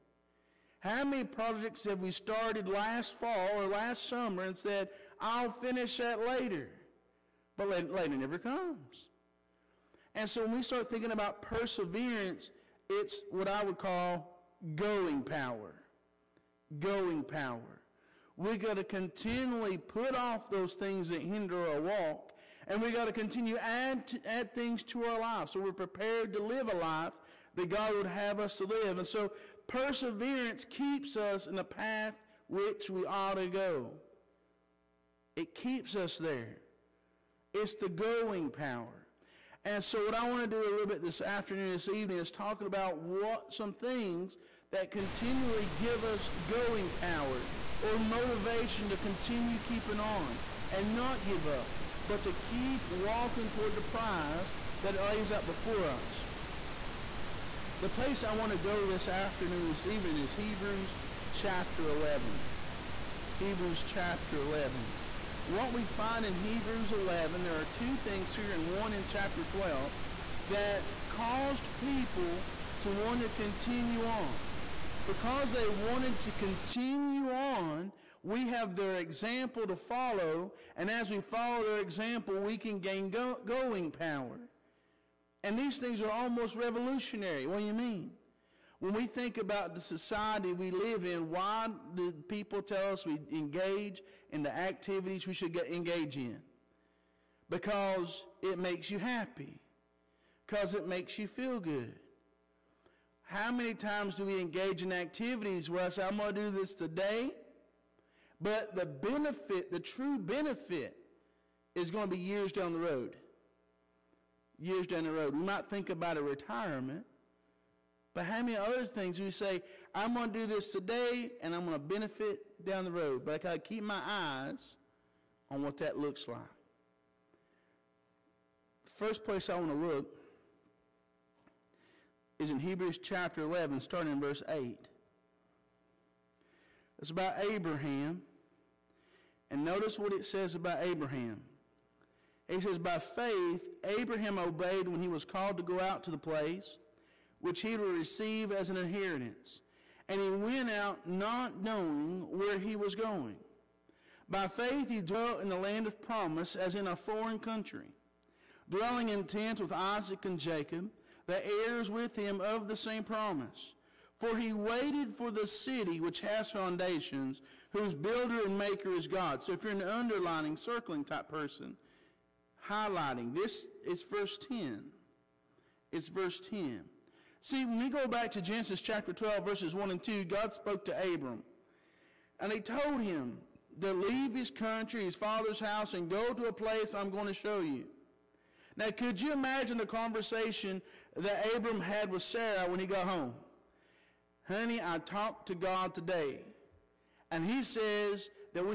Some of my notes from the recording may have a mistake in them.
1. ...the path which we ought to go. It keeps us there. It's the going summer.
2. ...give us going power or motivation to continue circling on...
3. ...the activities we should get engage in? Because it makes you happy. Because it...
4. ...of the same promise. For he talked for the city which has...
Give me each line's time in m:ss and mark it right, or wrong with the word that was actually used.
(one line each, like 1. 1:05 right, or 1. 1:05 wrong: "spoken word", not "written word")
1. 0:31 wrong: "power", not "summer"
2. 0:45 wrong: "keeping", not "circling"
3. 1:34 right
4. 2:42 wrong: "waited", not "talked".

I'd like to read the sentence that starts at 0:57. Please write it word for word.
The place I want to go this afternoon, this evening, is Hebrews chapter 11.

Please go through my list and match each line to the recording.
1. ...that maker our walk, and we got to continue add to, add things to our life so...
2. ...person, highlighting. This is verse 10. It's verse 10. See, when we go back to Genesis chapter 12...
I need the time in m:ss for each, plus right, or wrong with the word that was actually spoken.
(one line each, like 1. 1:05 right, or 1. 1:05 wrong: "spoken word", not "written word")
1. 0:21 wrong: "hinder", not "maker"
2. 2:51 right.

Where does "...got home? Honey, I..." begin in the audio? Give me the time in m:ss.
3:12.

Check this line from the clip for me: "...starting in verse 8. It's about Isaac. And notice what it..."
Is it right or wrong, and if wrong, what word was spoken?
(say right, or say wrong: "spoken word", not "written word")
wrong: "Abraham", not "Isaac".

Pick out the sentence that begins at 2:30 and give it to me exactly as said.
And he went out not knowing where he was going.